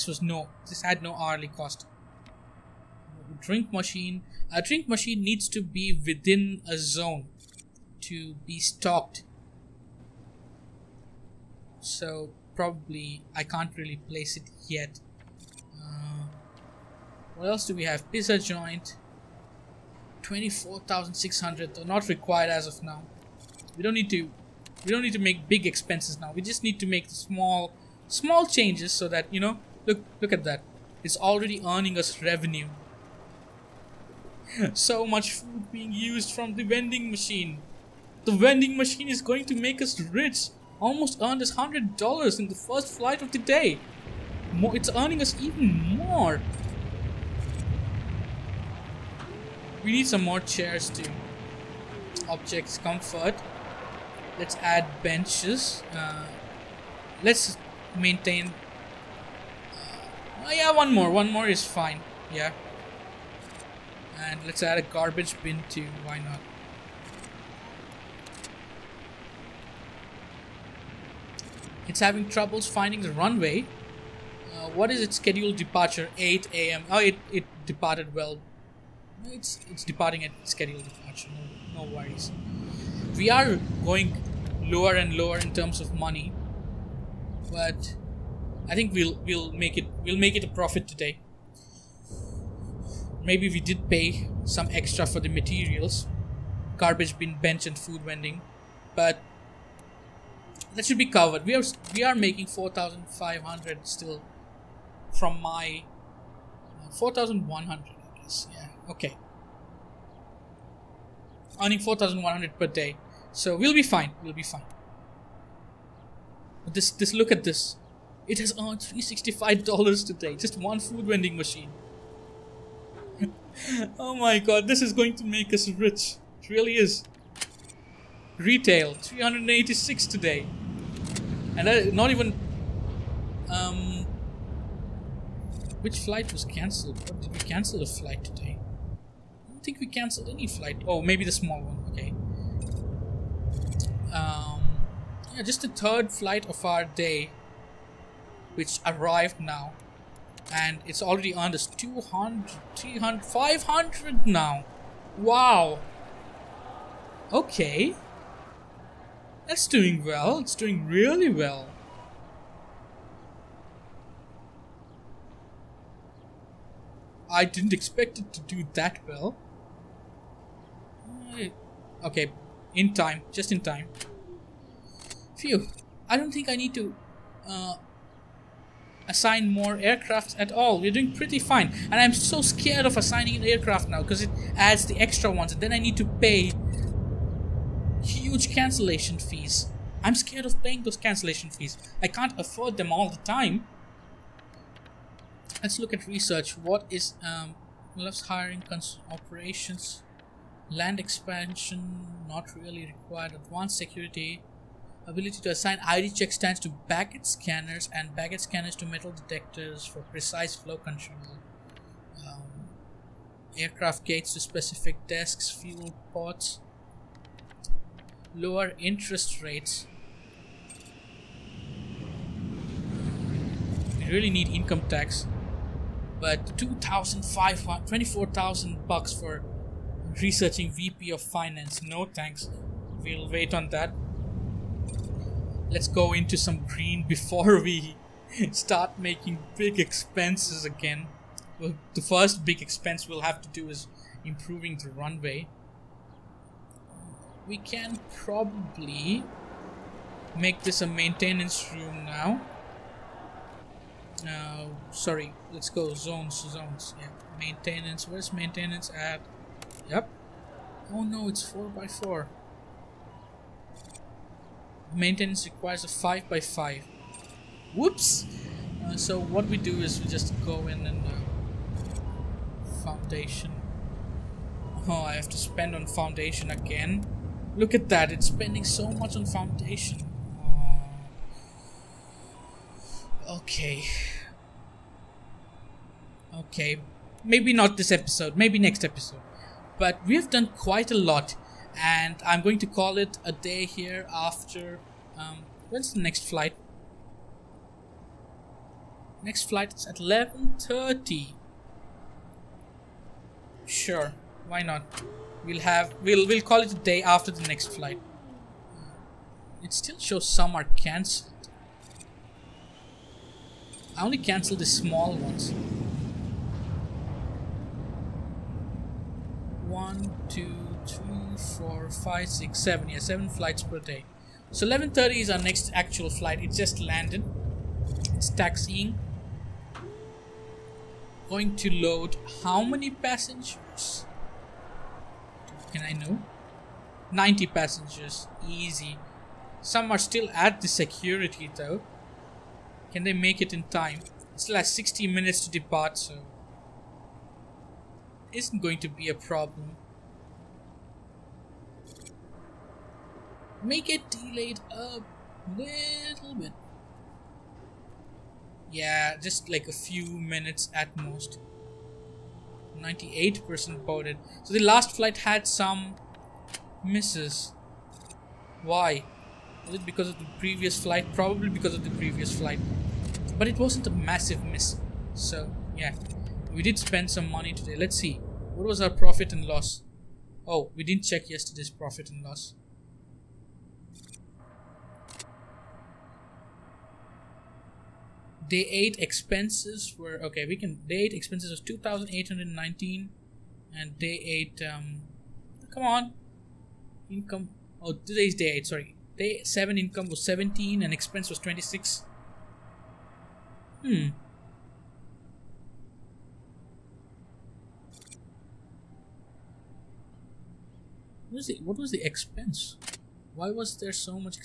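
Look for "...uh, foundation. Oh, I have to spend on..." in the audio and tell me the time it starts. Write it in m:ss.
4:31.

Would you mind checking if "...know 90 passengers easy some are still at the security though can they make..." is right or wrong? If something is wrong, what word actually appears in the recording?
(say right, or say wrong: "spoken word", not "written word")
right.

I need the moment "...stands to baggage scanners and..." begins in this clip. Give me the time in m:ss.
3:26.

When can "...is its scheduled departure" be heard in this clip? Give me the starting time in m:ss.
1:14.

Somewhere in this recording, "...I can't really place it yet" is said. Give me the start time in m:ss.
0:13.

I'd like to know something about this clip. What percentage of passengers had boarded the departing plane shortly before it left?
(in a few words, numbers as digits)
98%.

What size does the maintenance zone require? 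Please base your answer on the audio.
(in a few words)
5 by 5.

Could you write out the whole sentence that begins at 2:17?
What did we cancel a flight today?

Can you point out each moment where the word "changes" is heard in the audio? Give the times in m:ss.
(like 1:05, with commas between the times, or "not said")
0:28.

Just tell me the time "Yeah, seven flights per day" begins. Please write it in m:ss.
5:22.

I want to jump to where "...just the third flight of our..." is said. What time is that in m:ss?
2:25.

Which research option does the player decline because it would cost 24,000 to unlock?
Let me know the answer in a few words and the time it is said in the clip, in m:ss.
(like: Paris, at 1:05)
VP of Finance, at 3:50.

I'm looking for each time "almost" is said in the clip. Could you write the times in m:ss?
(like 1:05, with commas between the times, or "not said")
0:40.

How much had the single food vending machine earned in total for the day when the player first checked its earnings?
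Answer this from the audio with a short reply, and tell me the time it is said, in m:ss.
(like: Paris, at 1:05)
$365, at 1:58.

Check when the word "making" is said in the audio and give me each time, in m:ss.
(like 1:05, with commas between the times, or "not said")
1:42, 3:59.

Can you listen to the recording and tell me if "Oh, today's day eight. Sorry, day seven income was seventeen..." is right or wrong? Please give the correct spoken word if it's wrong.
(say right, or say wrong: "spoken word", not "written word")
right.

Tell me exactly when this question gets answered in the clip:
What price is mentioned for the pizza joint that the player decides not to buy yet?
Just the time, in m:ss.
0:20.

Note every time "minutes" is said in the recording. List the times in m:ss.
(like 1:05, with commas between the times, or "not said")
5:45, 6:00.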